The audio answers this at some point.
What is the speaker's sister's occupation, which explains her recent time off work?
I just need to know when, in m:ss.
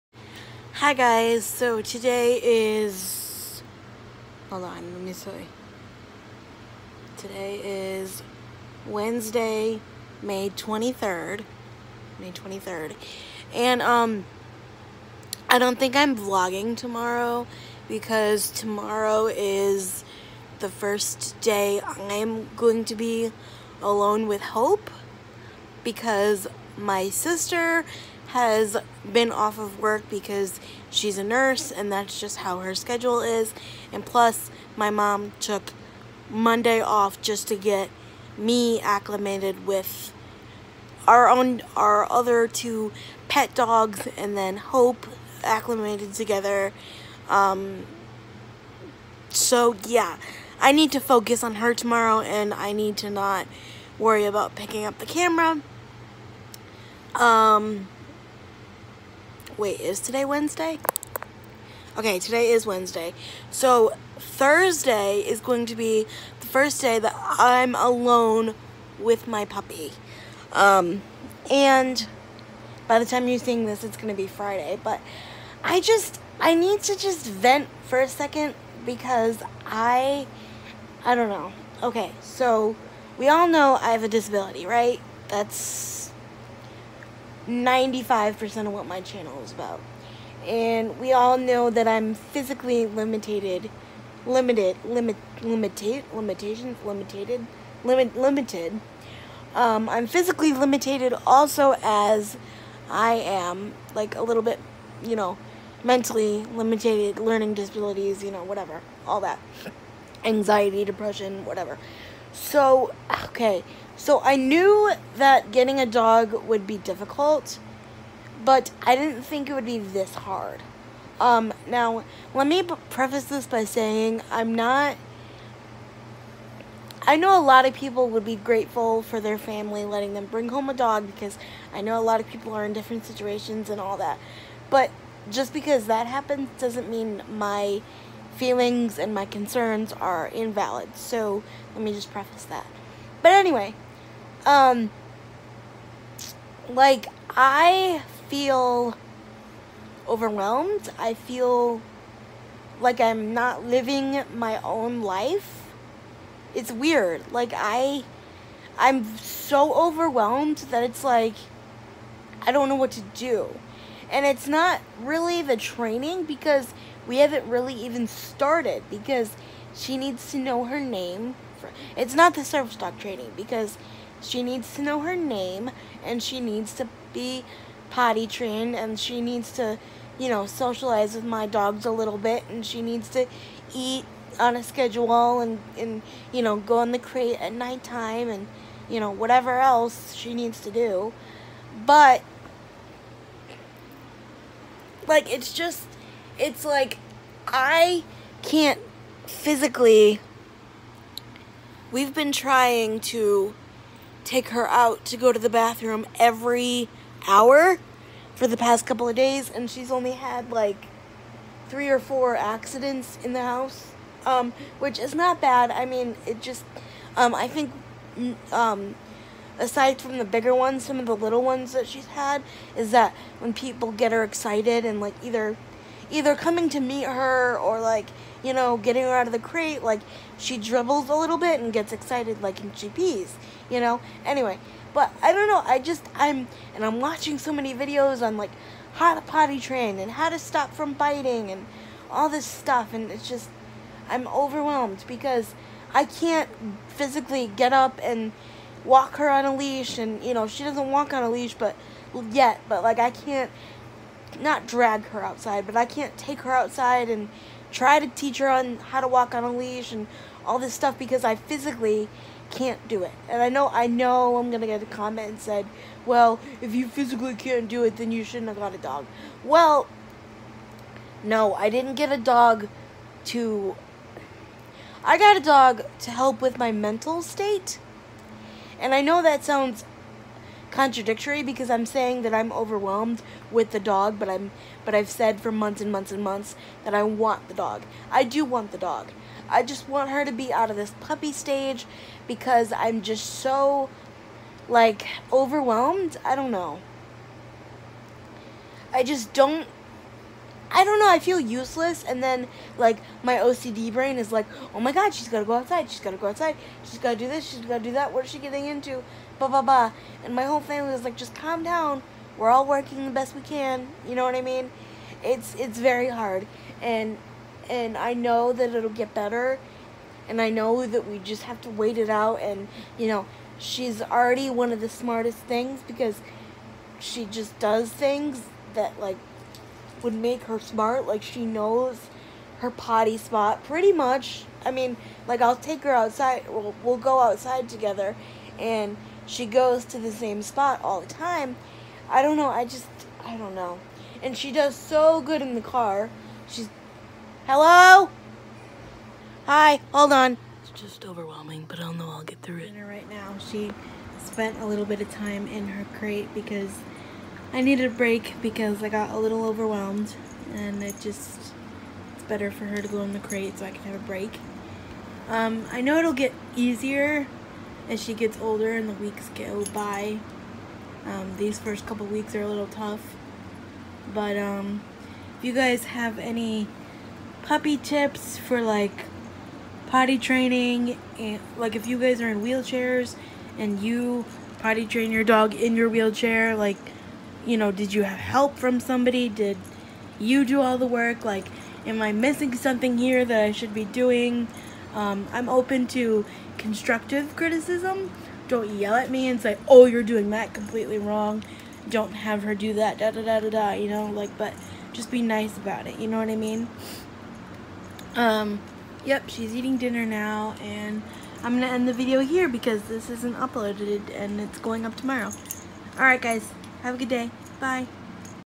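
0:31.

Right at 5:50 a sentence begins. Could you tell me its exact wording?
It's just overwhelming, but I'll know I'll get through it.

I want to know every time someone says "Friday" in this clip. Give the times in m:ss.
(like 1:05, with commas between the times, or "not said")
1:14.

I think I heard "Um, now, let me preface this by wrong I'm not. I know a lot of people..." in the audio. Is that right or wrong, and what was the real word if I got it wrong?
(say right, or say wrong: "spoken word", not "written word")
wrong: "saying", not "wrong".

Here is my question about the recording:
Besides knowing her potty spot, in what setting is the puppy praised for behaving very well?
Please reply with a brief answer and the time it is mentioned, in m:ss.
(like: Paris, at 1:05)
In the car, at 5:45.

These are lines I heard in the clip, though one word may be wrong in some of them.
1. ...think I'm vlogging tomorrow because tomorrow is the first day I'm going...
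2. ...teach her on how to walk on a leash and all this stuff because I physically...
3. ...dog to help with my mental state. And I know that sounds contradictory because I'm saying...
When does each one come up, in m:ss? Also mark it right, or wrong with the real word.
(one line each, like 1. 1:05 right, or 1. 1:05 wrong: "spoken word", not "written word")
1. 0:15 right
2. 4:18 right
3. 4:35 right.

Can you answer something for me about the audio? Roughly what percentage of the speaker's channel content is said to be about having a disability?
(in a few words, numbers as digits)
95%.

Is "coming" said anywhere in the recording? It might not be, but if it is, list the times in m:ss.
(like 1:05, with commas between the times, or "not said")
3:46.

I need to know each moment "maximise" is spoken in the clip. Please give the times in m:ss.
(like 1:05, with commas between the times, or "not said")
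not said.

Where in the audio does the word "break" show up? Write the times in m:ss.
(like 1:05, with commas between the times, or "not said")
5:57, 6:04.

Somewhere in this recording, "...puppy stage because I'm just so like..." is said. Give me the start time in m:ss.
4:51.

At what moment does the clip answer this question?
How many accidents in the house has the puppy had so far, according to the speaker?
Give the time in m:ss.
3:31.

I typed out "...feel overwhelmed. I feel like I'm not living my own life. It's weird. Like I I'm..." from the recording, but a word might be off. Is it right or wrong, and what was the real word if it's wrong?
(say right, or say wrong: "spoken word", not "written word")
right.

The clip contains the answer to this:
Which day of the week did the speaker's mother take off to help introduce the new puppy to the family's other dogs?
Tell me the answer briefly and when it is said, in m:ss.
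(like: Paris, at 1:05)
Monday, at 0:36.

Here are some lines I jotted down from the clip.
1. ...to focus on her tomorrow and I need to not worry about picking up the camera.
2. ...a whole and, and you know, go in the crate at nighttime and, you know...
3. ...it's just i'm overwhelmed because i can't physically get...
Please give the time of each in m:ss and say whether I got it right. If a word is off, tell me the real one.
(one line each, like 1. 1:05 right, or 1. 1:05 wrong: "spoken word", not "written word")
1. 0:50 right
2. 3:04 wrong: "schedule", not "whole"
3. 4:03 right.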